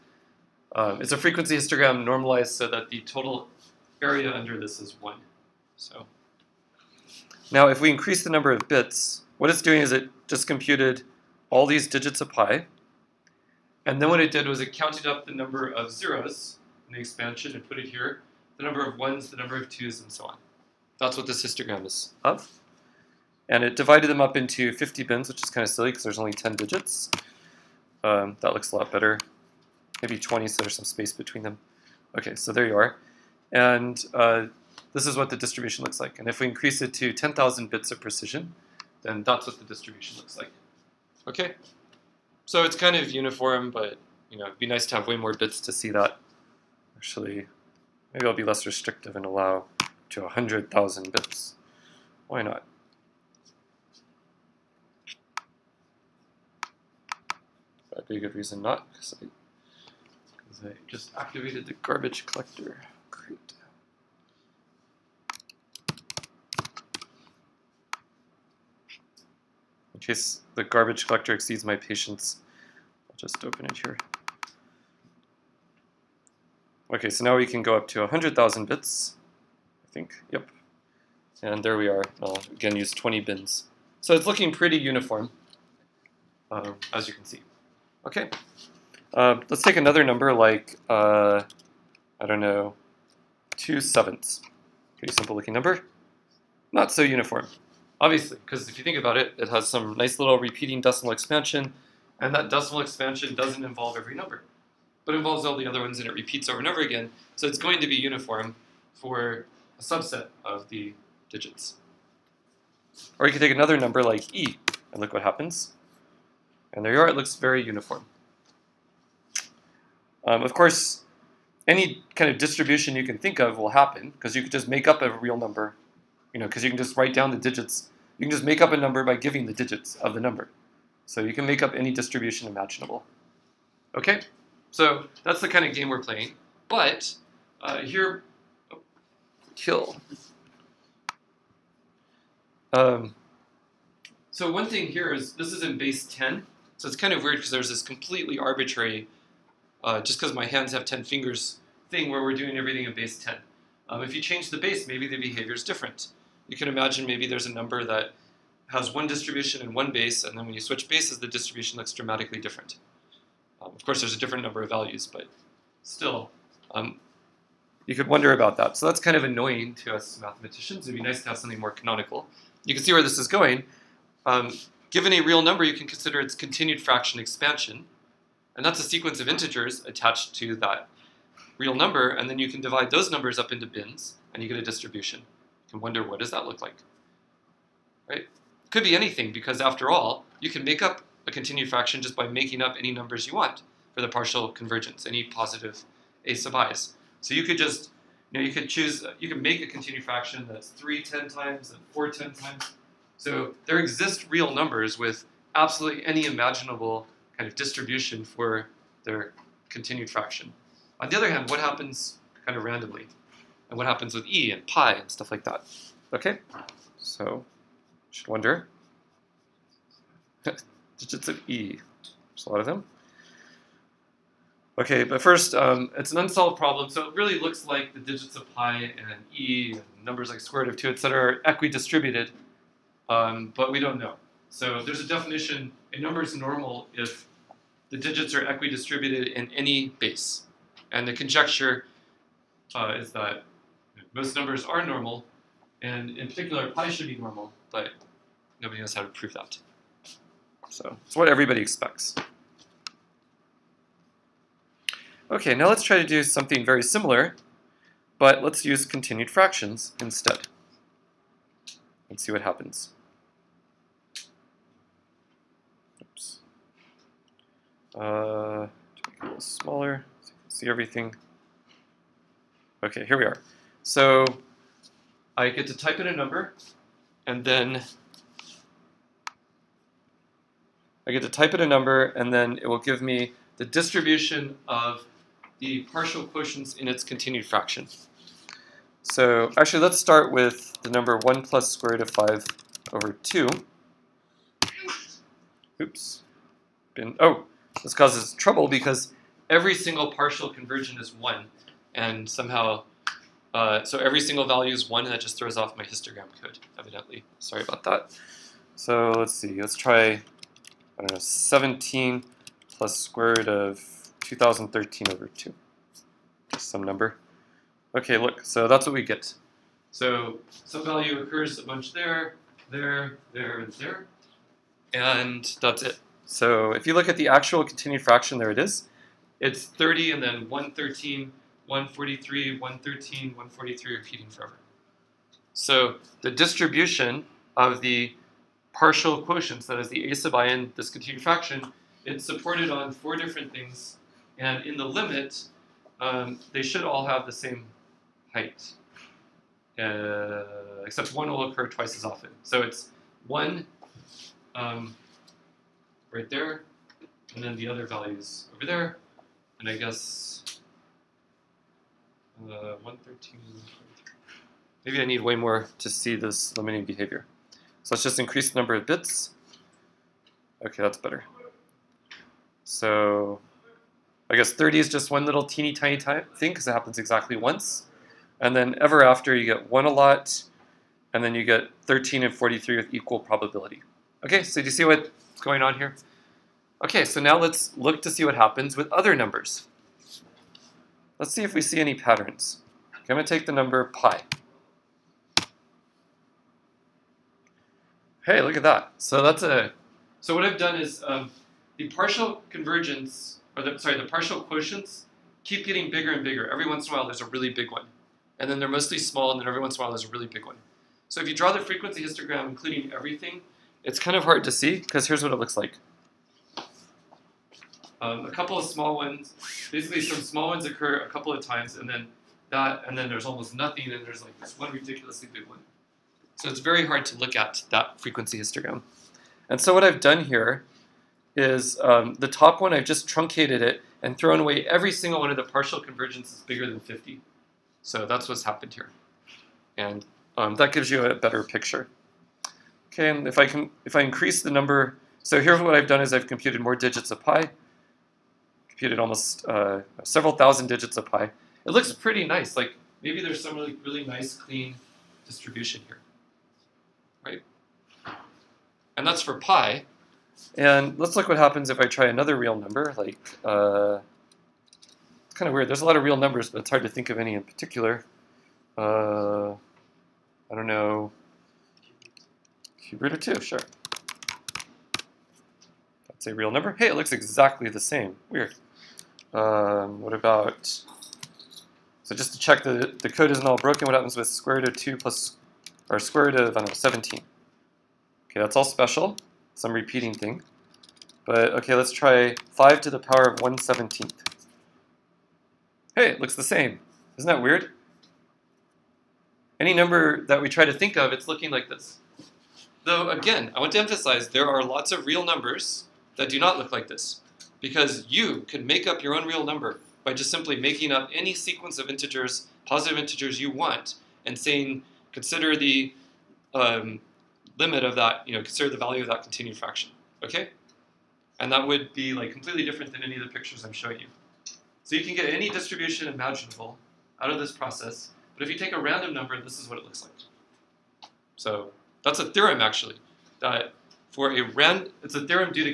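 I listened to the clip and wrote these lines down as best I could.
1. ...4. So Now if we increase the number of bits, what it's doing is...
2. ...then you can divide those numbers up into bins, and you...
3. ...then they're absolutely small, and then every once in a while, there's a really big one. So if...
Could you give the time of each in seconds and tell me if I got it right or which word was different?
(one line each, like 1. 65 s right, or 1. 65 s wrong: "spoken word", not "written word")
1. 5 s wrong: "1", not "4"
2. 182 s right
3. 408 s wrong: "mostly", not "absolutely".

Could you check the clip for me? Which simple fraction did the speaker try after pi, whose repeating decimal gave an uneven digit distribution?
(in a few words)
2/7.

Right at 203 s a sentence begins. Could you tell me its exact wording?
So there exist real numbers with absolutely any imaginable kind of distribution for their continued fraction.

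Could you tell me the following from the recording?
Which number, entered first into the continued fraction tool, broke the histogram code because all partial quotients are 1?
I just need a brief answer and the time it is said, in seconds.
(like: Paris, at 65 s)
1 plus square root of 5 over 2, at 291 s.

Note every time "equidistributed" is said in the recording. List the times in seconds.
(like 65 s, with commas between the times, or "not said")
231 s, 238 s.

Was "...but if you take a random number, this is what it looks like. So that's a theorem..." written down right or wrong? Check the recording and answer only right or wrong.
right.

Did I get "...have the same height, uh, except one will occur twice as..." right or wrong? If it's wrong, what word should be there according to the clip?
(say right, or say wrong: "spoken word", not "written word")
right.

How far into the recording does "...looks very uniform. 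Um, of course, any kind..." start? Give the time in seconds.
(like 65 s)
117 s.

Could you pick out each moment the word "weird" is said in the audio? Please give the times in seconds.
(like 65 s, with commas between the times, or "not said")
147 s, 465 s, 478 s, 497 s.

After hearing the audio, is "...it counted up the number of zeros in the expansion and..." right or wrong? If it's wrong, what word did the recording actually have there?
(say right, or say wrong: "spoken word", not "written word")
right.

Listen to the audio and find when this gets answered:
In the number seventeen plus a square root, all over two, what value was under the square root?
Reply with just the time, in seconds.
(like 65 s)
314 s.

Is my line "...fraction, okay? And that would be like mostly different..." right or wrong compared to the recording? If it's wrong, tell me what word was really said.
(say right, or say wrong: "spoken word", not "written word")
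wrong: "completely", not "mostly".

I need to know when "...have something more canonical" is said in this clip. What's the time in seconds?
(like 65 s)
171 s.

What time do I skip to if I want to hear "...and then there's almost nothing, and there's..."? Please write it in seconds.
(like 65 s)
422 s.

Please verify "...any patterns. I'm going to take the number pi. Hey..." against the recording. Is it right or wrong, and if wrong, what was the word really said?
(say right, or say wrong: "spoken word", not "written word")
right.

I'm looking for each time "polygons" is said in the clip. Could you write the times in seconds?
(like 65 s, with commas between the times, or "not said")
not said.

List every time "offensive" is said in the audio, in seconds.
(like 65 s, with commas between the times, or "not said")
not said.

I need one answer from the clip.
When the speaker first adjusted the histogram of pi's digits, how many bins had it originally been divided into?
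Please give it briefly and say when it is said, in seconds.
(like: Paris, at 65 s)
50, at 24 s.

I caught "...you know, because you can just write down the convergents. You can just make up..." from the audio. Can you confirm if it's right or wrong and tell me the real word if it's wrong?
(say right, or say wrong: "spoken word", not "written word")
wrong: "digits", not "convergents".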